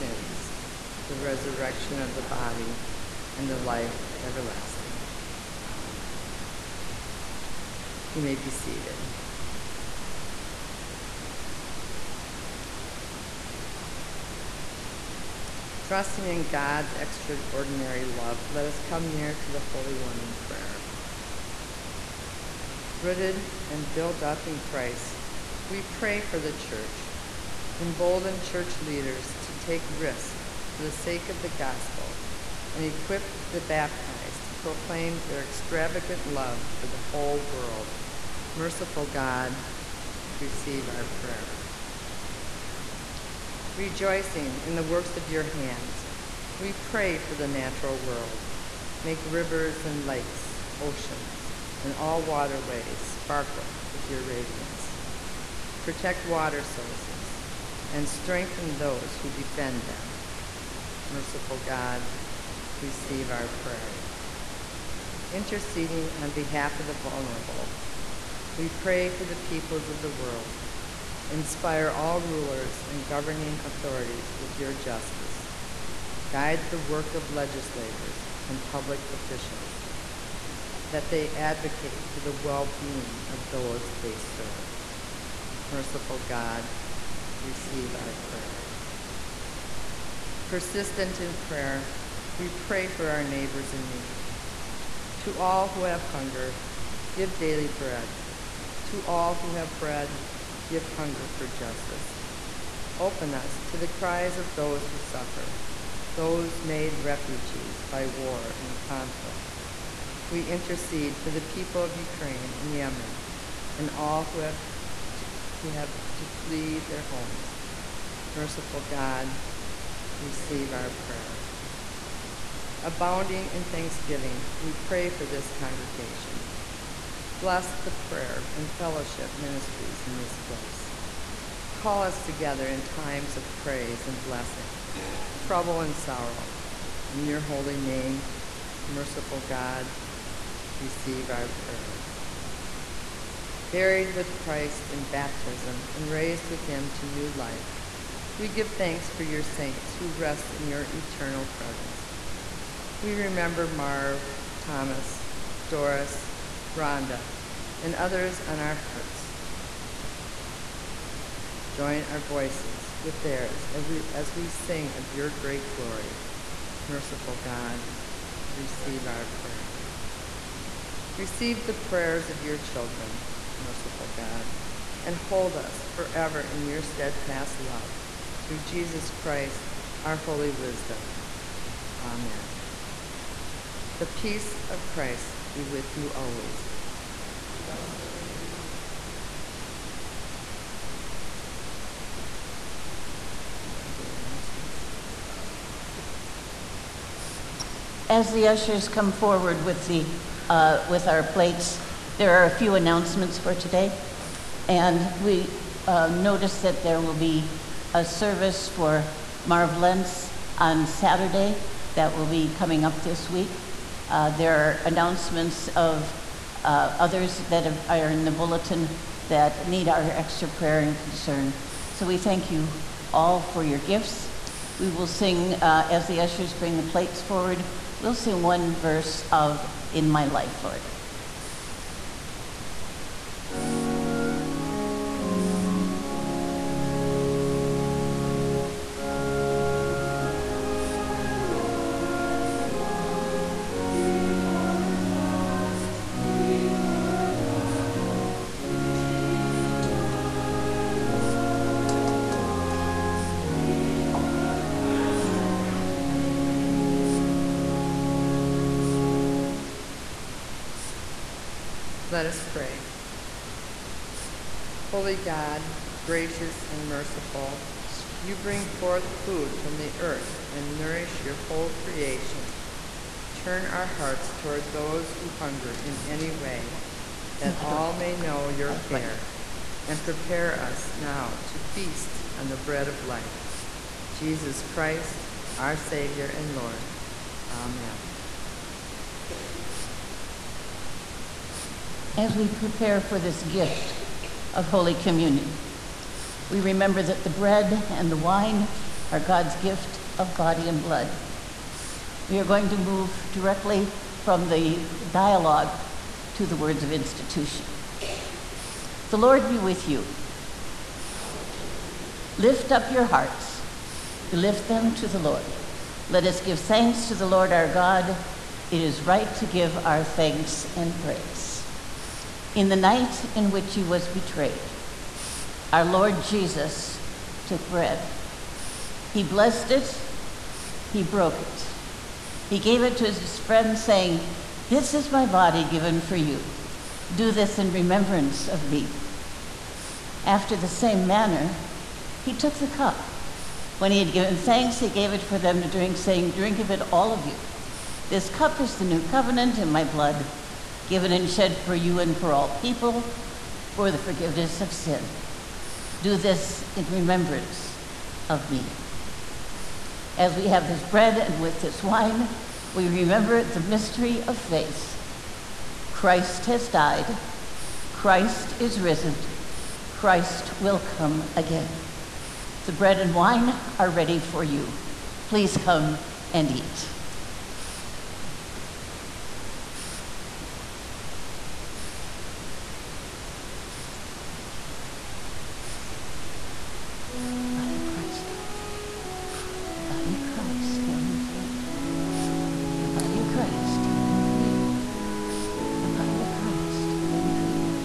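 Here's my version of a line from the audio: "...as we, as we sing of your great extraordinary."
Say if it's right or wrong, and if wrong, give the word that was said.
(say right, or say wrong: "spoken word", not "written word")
wrong: "glory", not "extraordinary".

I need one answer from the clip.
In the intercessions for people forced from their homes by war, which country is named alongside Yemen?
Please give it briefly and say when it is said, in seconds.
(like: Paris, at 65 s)
Ukraine, at 111 s.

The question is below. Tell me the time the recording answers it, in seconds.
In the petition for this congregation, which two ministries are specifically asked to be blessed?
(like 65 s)
127 s.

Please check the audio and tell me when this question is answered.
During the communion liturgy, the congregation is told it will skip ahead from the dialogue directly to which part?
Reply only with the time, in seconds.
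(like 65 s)
306 s.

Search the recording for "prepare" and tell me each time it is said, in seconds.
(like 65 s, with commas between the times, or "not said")
280 s, 292 s.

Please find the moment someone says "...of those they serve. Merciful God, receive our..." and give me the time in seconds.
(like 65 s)
83 s.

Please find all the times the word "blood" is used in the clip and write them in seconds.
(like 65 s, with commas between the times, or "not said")
300 s, 349 s.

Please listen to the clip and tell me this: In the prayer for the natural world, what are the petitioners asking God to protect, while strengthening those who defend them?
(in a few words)
Water sources.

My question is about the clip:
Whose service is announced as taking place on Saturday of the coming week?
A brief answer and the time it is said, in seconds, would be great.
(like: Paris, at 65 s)
Marv Lentz, at 209 s.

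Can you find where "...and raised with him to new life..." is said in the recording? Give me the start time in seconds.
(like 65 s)
145 s.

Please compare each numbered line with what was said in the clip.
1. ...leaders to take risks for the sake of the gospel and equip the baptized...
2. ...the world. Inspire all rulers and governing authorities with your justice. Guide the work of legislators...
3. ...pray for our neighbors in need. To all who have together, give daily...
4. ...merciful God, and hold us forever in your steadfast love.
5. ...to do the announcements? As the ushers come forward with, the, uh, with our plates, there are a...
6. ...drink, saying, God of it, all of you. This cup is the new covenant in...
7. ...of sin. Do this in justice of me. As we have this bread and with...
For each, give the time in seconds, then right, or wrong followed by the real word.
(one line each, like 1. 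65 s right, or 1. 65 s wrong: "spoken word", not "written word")
1. 28 s right
2. 70 s right
3. 92 s wrong: "hunger", not "together"
4. 173 s right
5. 193 s right
6. 345 s wrong: "Drink", not "God"
7. 354 s wrong: "remembrance", not "justice".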